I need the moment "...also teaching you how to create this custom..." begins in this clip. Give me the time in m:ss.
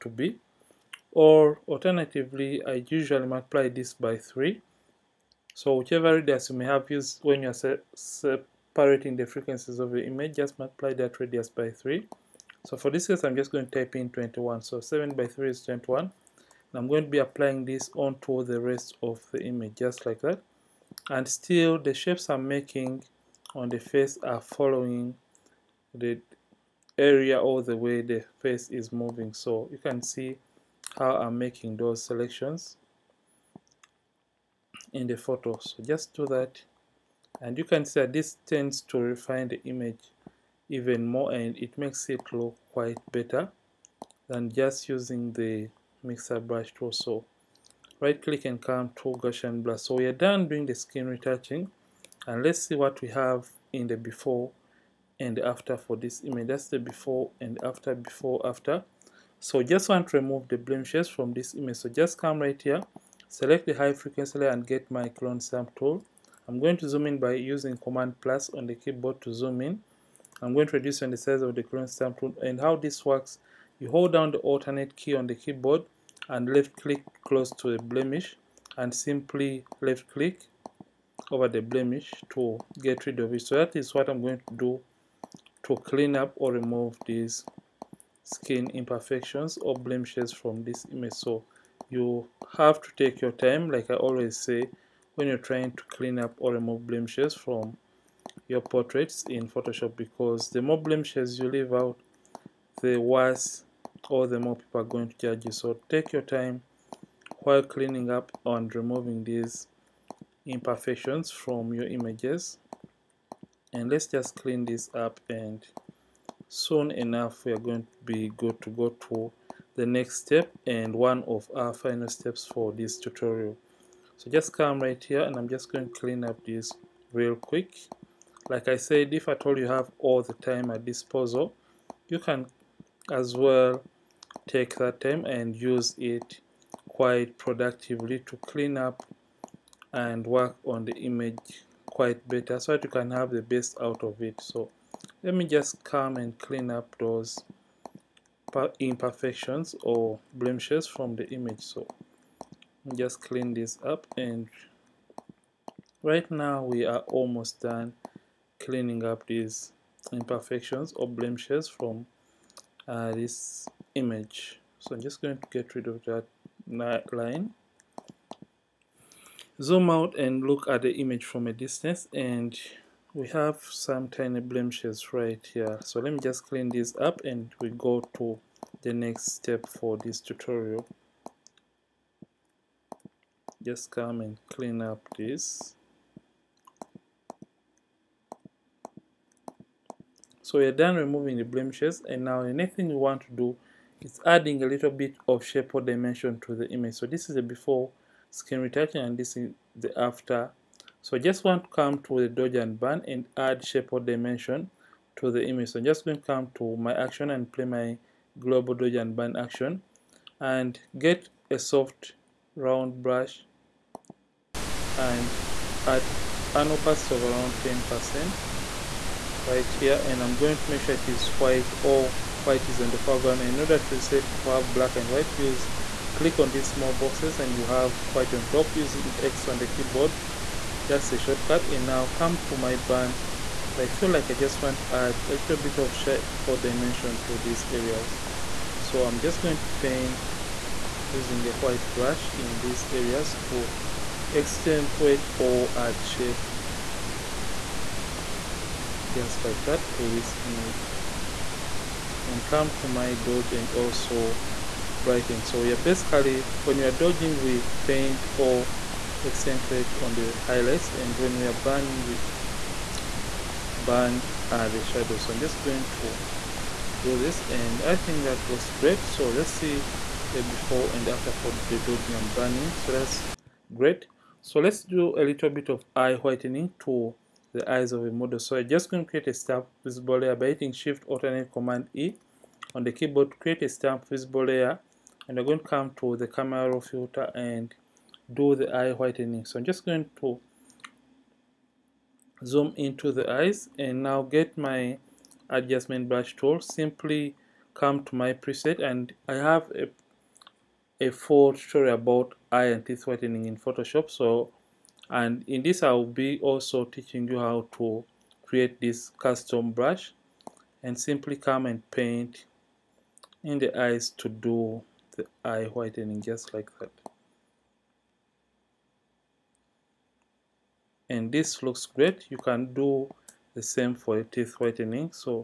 5:06.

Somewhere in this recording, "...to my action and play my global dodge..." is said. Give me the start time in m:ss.
3:26.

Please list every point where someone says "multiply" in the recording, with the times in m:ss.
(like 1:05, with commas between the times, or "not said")
0:03, 0:10.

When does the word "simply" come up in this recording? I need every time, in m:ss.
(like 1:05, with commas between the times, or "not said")
1:18, 4:56, 5:10.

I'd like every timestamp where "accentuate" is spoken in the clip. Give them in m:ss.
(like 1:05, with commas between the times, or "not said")
4:04, 4:19.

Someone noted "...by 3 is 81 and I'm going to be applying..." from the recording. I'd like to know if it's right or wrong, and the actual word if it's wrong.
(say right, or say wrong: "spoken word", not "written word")
wrong: "21", not "81".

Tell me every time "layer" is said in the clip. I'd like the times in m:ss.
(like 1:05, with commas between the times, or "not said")
1:04, 4:40, 4:44.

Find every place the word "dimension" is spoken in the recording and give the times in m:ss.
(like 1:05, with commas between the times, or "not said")
3:15, 3:24, 3:56.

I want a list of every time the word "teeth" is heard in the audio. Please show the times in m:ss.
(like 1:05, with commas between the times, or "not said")
5:02, 5:24.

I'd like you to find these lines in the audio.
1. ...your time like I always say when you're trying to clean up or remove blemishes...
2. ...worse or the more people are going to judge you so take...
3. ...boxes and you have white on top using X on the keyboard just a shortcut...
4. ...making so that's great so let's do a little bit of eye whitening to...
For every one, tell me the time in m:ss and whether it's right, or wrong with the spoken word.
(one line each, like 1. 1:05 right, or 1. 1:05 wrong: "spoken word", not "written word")
1. 1:33 right
2. 1:42 right
3. 3:46 right
4. 4:32 wrong: "burning", not "making".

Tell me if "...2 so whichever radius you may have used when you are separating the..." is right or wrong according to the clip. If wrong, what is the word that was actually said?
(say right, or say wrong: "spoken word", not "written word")
wrong: "3", not "2".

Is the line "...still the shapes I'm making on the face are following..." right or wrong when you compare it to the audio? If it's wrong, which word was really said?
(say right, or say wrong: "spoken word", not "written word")
right.